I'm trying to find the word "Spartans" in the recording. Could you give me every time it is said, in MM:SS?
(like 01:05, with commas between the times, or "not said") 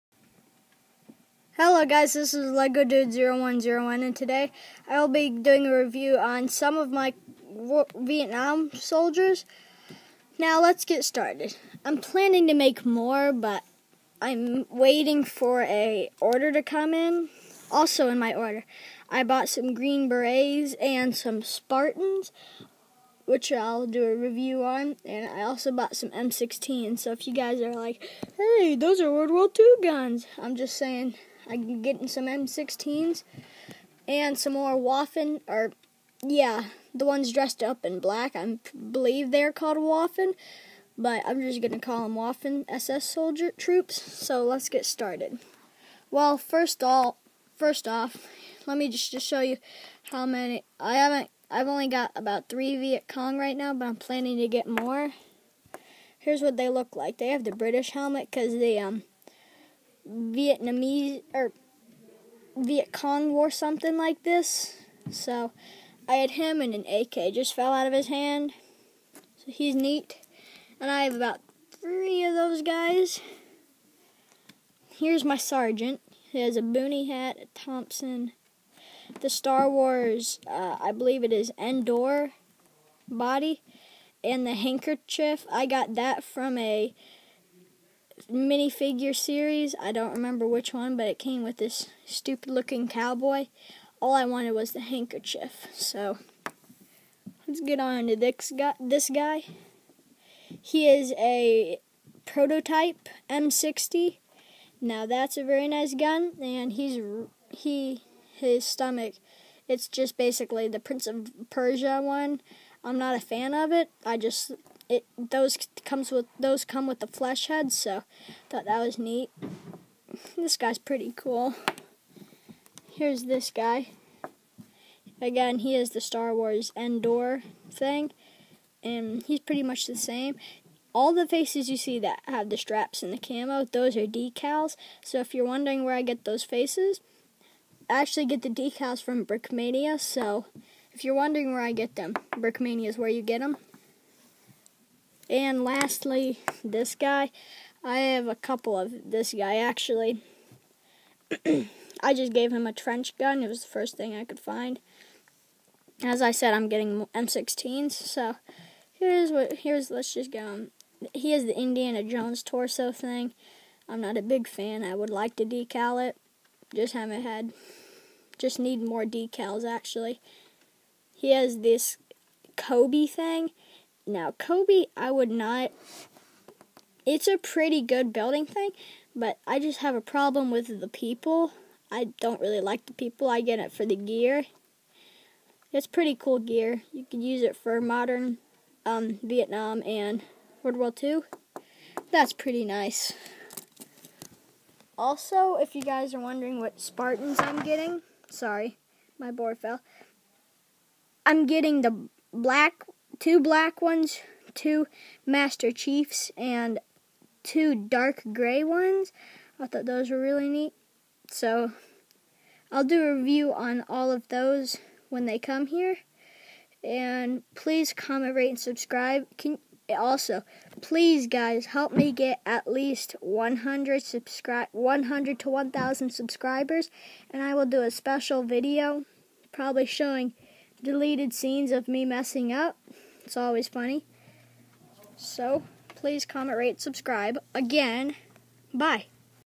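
00:21, 03:16.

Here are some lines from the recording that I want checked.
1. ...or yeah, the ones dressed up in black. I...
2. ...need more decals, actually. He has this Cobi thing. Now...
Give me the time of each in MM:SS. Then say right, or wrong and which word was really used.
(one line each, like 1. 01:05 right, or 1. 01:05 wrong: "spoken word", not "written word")
1. 00:35 right
2. 02:48 right.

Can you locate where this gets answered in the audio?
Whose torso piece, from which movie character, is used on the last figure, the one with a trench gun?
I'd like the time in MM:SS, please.
02:41.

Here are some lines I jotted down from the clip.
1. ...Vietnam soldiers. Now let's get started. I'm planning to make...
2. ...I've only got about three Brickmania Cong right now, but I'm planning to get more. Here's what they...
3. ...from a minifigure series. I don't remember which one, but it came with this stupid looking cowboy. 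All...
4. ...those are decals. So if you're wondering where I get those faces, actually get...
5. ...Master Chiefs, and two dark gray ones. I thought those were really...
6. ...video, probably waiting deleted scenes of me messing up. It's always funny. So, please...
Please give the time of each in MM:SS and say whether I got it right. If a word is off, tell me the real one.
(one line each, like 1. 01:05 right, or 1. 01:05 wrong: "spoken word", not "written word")
1. 00:07 right
2. 00:51 wrong: "Viet", not "Brickmania"
3. 01:26 right
4. 02:13 right
5. 03:25 right
6. 03:48 wrong: "showing", not "waiting".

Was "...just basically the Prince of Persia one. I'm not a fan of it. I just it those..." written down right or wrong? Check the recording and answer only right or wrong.
right.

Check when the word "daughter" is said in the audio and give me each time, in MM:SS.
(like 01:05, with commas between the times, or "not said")
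not said.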